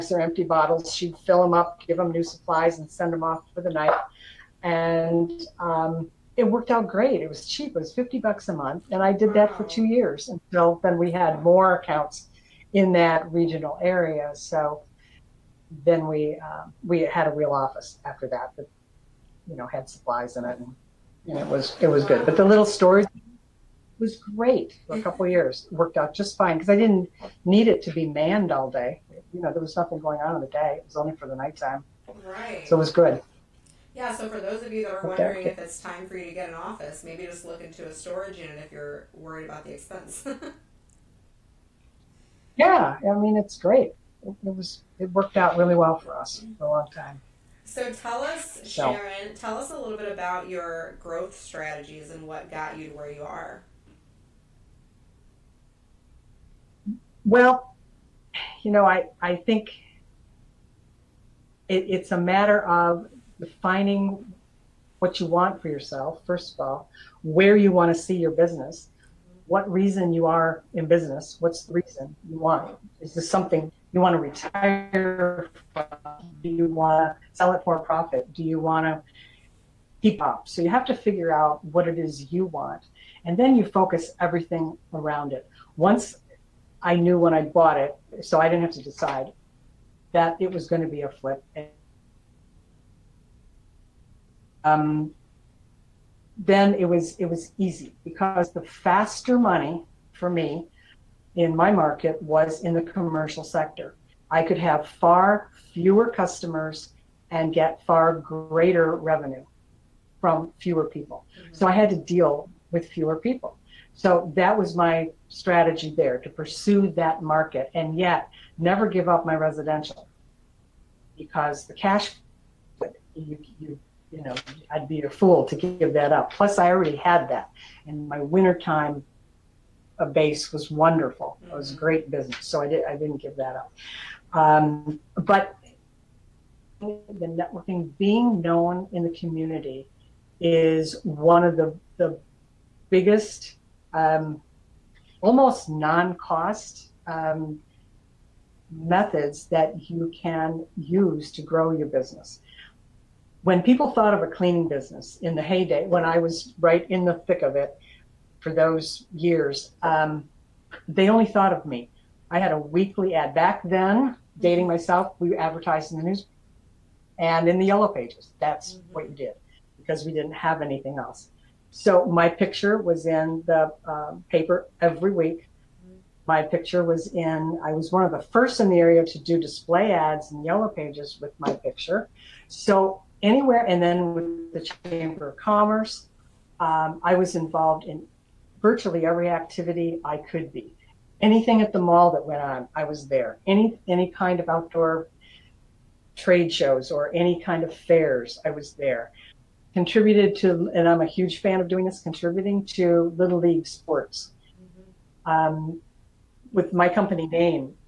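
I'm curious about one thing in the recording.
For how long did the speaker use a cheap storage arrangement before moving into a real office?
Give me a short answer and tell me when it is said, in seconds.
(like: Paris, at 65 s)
2 years, at 9 s.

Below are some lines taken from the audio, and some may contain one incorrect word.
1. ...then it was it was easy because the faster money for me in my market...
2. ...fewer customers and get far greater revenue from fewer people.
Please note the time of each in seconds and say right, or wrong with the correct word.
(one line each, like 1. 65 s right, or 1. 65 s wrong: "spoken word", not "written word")
1. 96 s right
2. 105 s right.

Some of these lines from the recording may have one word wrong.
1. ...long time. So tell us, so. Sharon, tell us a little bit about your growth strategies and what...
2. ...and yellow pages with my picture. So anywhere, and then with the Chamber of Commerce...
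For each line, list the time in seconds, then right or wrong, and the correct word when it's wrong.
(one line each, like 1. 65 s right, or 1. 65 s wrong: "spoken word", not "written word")
1. 46 s right
2. 180 s right.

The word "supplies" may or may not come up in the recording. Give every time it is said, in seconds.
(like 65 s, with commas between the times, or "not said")
2 s, 19 s.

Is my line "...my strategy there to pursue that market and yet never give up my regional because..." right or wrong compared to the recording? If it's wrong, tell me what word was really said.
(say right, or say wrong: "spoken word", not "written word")
wrong: "residential", not "regional".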